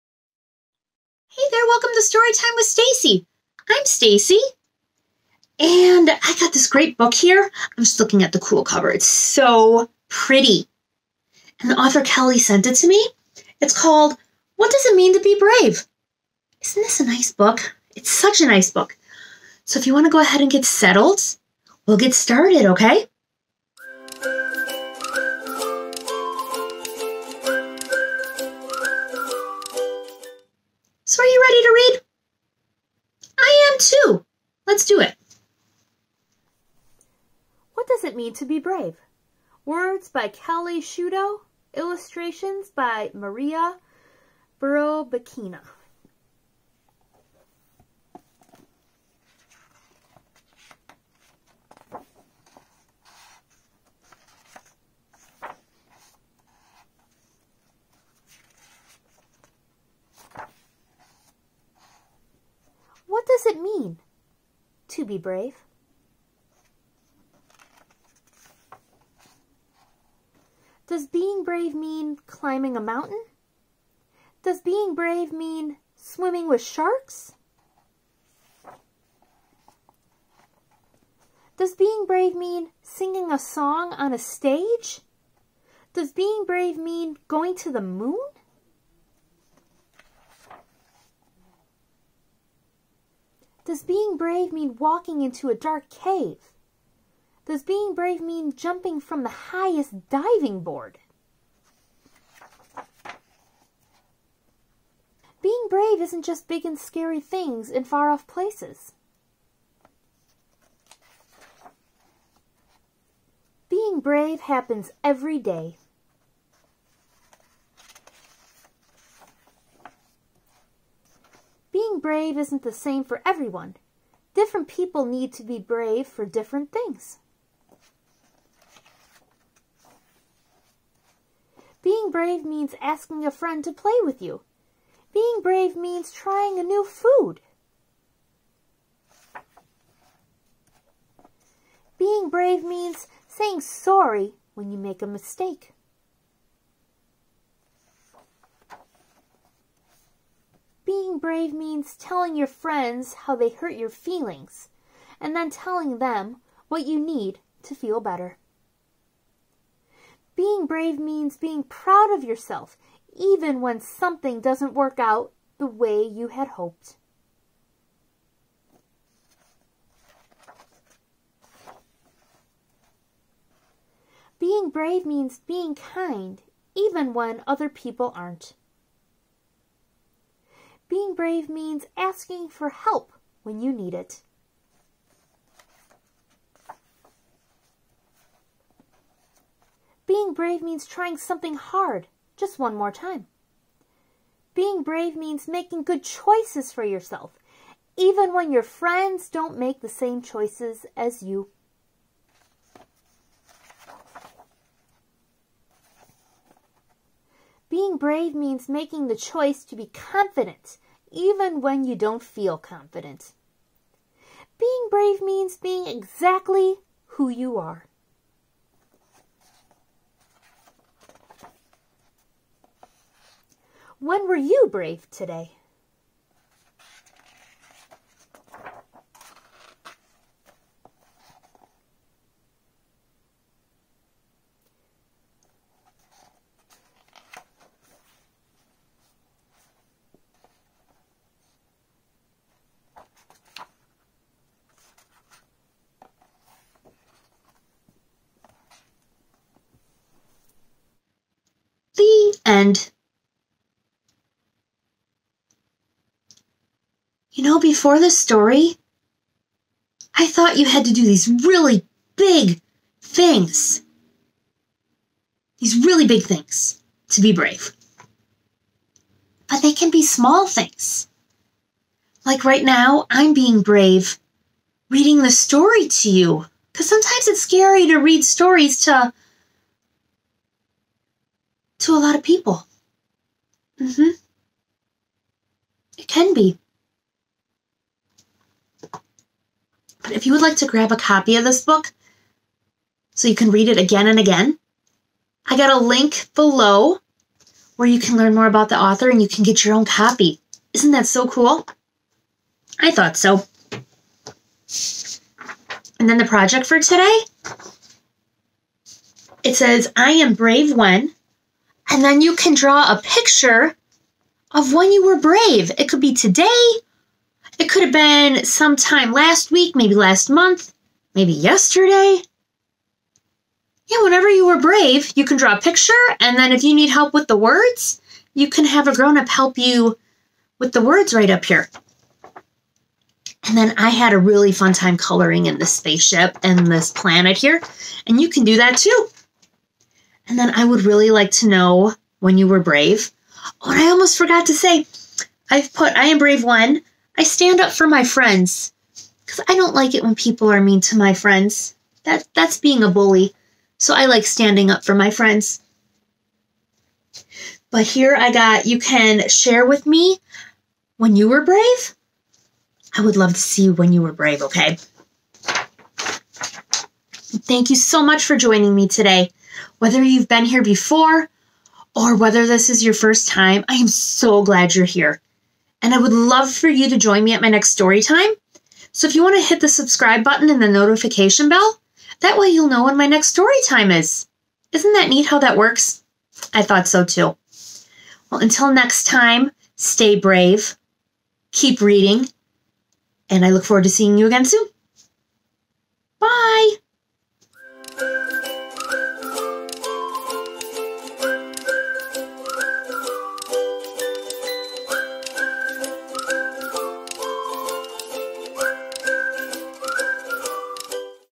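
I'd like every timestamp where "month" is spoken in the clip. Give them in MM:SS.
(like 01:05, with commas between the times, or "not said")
05:20.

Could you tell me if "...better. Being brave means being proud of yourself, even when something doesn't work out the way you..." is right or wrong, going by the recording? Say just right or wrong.
right.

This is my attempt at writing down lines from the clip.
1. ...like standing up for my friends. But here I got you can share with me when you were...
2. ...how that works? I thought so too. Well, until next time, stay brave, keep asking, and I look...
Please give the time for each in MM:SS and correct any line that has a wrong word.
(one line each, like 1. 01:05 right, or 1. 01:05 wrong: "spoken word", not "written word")
1. 05:54 right
2. 06:25 wrong: "reading", not "asking".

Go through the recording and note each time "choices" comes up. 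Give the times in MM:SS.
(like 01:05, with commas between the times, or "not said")
03:16, 03:20, 03:29.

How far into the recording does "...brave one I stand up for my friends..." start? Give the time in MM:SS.
05:46.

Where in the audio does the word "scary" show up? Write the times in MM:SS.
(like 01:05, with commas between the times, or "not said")
01:46, 04:37.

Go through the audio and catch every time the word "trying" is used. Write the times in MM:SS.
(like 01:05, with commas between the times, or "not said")
02:16, 03:10.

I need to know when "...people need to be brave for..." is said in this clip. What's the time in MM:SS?
02:04.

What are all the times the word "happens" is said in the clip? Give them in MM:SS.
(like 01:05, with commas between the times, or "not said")
01:54.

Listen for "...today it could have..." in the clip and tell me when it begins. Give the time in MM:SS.
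05:16.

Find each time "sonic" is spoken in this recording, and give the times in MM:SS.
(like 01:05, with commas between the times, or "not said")
not said.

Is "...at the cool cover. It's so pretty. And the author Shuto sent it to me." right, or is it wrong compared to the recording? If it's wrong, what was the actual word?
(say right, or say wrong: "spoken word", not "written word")
wrong: "Kelly", not "Shuto".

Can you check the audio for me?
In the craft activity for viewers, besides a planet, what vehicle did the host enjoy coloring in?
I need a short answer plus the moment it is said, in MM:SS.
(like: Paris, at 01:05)
Spaceship, at 05:35.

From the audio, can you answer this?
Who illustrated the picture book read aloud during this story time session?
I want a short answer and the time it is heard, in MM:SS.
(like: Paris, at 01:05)
Maria Burobakina, at 00:43.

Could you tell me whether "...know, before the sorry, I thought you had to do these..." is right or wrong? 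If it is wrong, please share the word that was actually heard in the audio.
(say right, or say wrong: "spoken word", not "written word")
wrong: "story", not "sorry".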